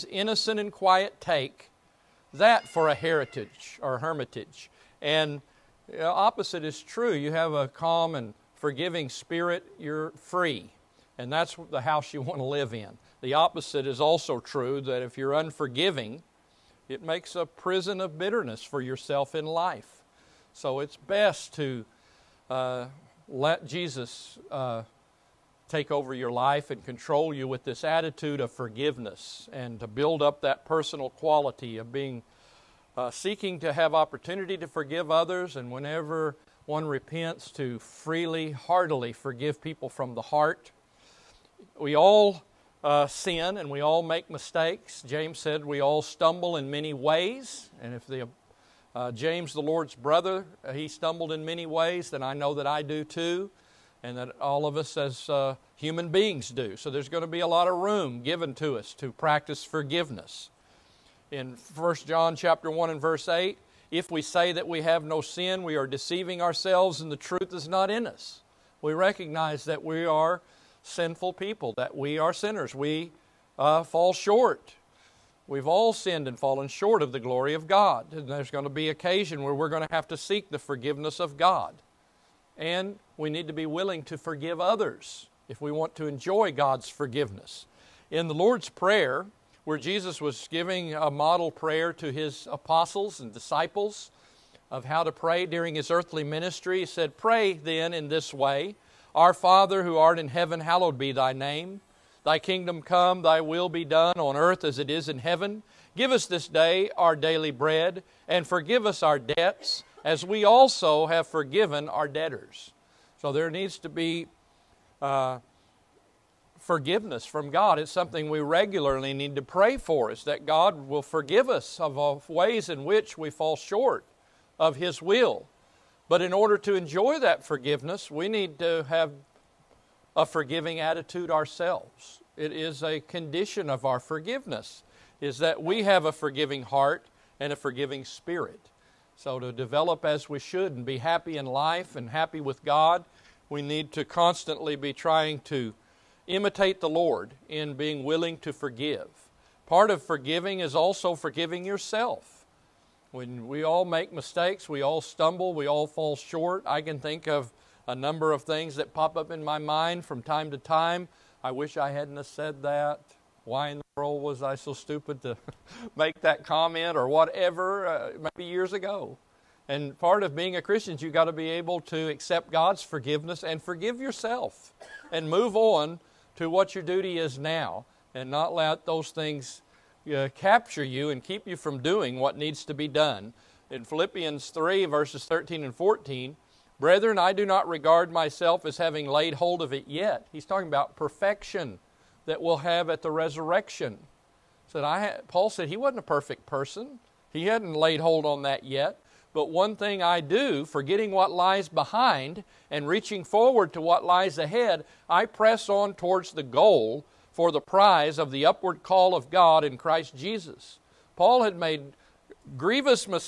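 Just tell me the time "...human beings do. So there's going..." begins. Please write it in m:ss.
0:55.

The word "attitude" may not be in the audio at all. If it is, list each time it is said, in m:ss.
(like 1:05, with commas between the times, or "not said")
0:27, 2:10.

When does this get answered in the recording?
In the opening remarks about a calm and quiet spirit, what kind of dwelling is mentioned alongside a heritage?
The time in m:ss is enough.
0:03.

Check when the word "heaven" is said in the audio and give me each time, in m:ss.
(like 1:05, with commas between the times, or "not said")
1:40, 1:45.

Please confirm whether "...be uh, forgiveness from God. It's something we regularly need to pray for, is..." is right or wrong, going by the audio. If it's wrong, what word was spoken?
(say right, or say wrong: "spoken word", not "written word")
right.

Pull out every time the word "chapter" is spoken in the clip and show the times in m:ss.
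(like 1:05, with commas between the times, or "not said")
1:02.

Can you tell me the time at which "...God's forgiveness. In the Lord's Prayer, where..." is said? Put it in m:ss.
1:26.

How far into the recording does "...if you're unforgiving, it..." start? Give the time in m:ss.
0:15.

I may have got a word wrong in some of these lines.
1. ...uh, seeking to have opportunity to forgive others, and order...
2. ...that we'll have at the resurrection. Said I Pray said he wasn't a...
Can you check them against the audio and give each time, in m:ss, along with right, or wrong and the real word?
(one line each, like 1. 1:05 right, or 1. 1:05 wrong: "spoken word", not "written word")
1. 0:32 wrong: "whenever", not "order"
2. 3:12 wrong: "Paul", not "Pray".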